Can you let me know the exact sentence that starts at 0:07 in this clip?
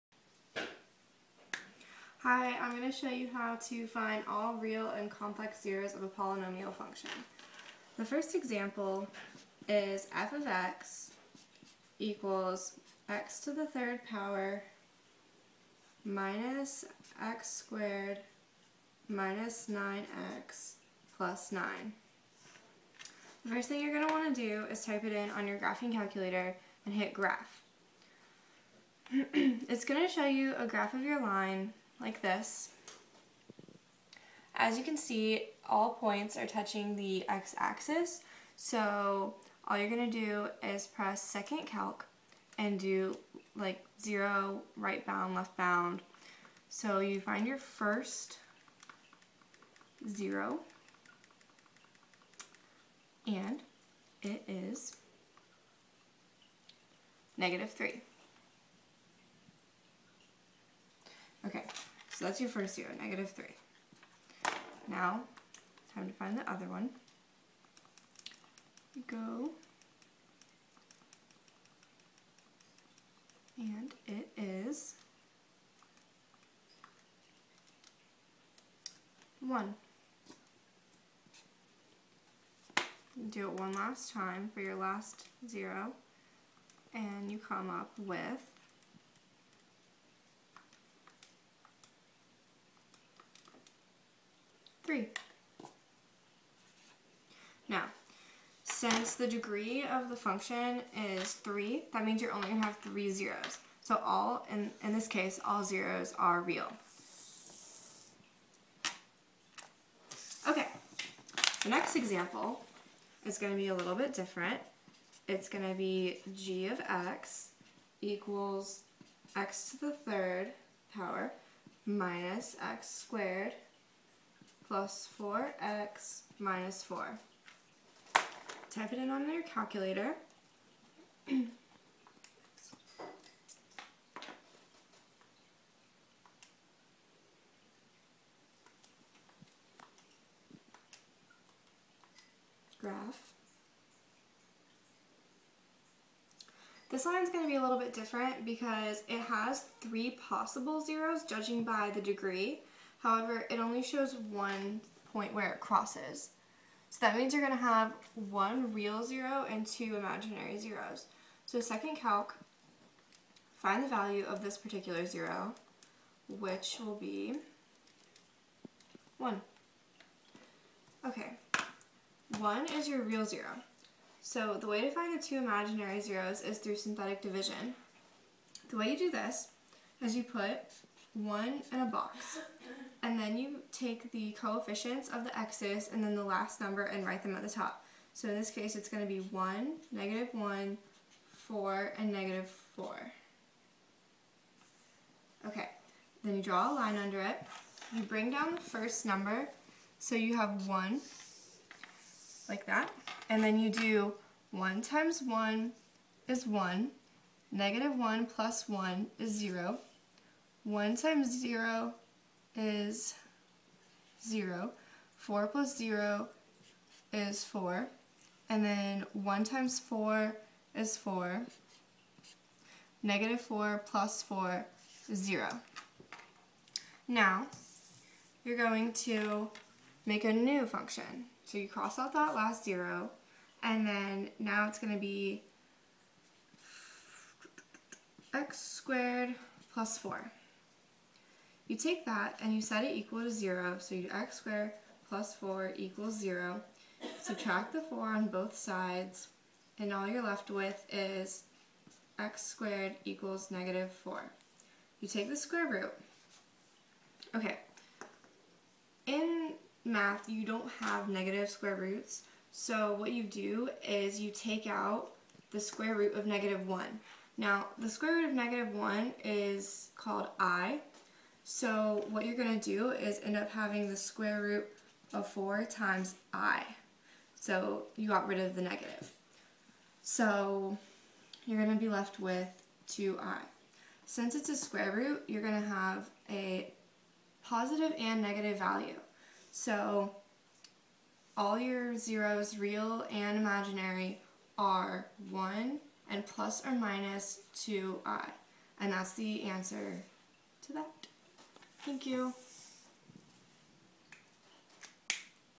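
The first example is f of x equals x to the third power minus x squared minus 9x plus 9.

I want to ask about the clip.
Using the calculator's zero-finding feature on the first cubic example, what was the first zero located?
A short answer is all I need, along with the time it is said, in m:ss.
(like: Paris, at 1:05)
-3, at 0:57.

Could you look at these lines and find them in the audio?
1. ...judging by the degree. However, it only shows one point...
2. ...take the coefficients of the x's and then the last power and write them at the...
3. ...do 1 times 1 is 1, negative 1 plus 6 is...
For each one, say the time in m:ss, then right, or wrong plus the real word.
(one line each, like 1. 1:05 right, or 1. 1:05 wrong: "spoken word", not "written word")
1. 2:31 right
2. 3:03 wrong: "number", not "power"
3. 3:23 wrong: "1", not "6".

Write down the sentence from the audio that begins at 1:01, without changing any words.
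Okay, so that's your first zero, negative 3.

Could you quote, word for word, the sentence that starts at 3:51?
So you cross out that last 0, and then now it's going to be x squared plus 4.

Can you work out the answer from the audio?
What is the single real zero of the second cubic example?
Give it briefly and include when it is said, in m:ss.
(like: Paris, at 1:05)
1, at 2:46.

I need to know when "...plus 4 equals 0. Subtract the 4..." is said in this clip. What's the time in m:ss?
4:05.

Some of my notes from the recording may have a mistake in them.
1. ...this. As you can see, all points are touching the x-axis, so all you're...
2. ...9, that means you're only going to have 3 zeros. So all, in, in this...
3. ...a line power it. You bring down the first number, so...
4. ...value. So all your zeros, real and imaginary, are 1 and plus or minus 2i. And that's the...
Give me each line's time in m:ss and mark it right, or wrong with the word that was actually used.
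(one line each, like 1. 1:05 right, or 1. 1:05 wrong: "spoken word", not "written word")
1. 0:32 right
2. 1:41 wrong: "3", not "9"
3. 3:16 wrong: "under", not "power"
4. 4:48 right.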